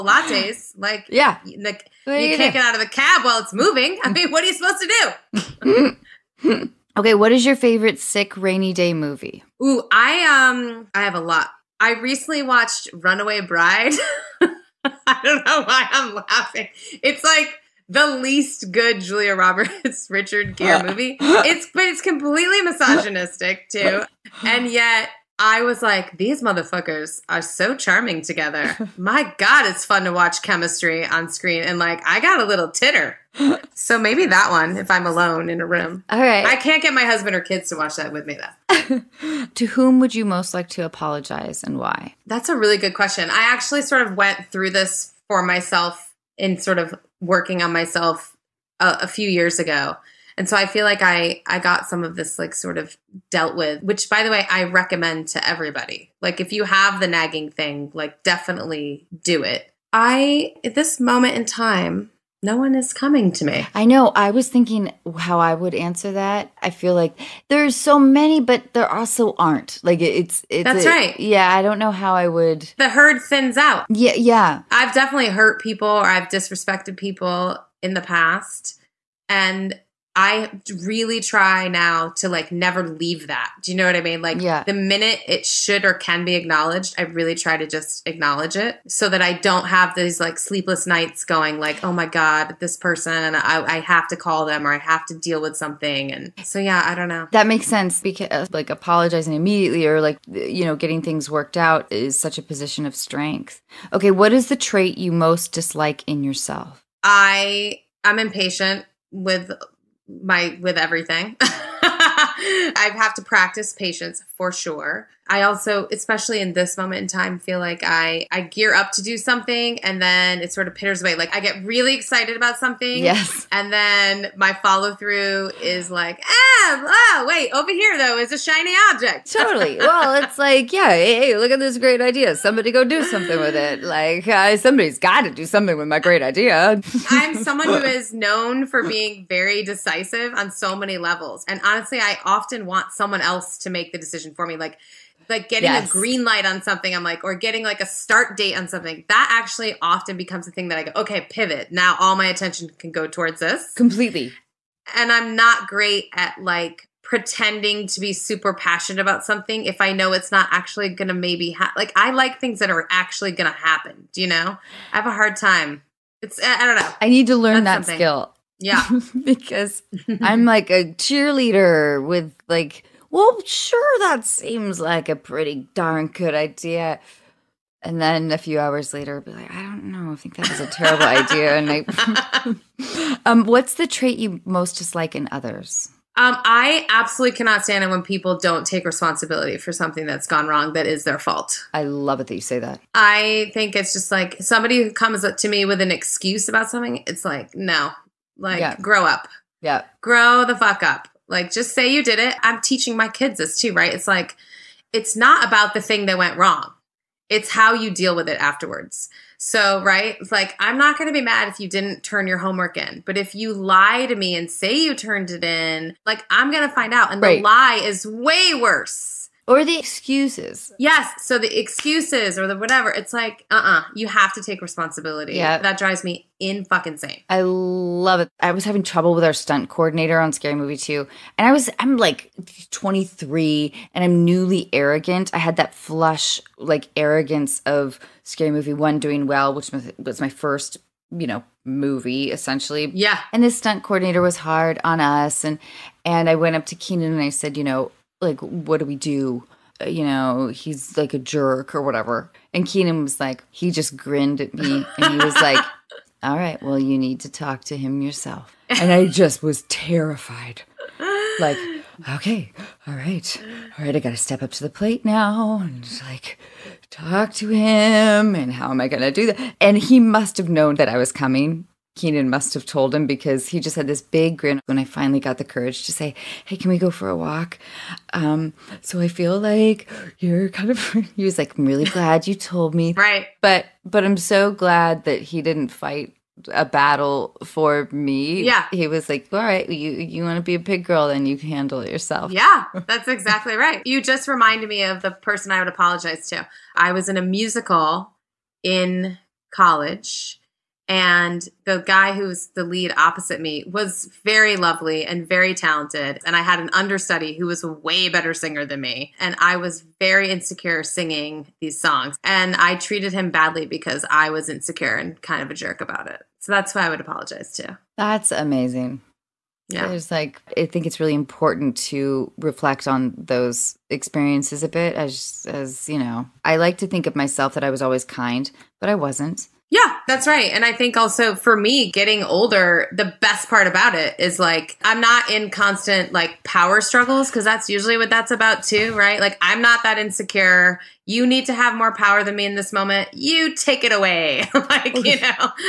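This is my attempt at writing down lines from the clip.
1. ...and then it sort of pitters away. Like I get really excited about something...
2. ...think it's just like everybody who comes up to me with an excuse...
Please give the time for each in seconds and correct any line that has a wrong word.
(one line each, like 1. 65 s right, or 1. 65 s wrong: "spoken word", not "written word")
1. 119 s right
2. 193 s wrong: "somebody", not "everybody".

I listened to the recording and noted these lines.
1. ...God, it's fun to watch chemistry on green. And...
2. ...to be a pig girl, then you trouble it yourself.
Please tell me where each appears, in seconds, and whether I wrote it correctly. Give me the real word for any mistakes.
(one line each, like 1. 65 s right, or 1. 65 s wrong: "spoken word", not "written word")
1. 29 s wrong: "screen", not "green"
2. 290 s wrong: "handle", not "trouble".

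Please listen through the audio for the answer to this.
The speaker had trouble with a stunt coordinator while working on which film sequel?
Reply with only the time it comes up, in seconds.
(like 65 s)
230 s.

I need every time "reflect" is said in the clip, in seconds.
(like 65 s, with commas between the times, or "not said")
322 s.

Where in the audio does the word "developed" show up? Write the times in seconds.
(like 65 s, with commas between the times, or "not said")
not said.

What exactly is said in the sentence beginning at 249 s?
Uh, you know, he's like a jerk or whatever.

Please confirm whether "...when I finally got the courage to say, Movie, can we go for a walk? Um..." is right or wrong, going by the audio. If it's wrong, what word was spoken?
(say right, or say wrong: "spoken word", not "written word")
wrong: "Hey", not "Movie".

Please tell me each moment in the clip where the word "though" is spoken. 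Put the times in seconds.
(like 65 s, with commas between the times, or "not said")
38 s, 127 s.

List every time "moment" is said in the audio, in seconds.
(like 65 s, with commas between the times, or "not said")
60 s, 116 s, 342 s.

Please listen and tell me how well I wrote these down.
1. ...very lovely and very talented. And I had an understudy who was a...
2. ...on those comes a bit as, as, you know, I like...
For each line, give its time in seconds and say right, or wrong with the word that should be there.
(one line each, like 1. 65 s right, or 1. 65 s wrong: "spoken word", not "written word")
1. 304 s right
2. 322 s wrong: "experiences", not "comes".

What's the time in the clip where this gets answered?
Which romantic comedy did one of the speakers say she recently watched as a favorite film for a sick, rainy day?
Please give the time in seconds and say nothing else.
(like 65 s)
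12 s.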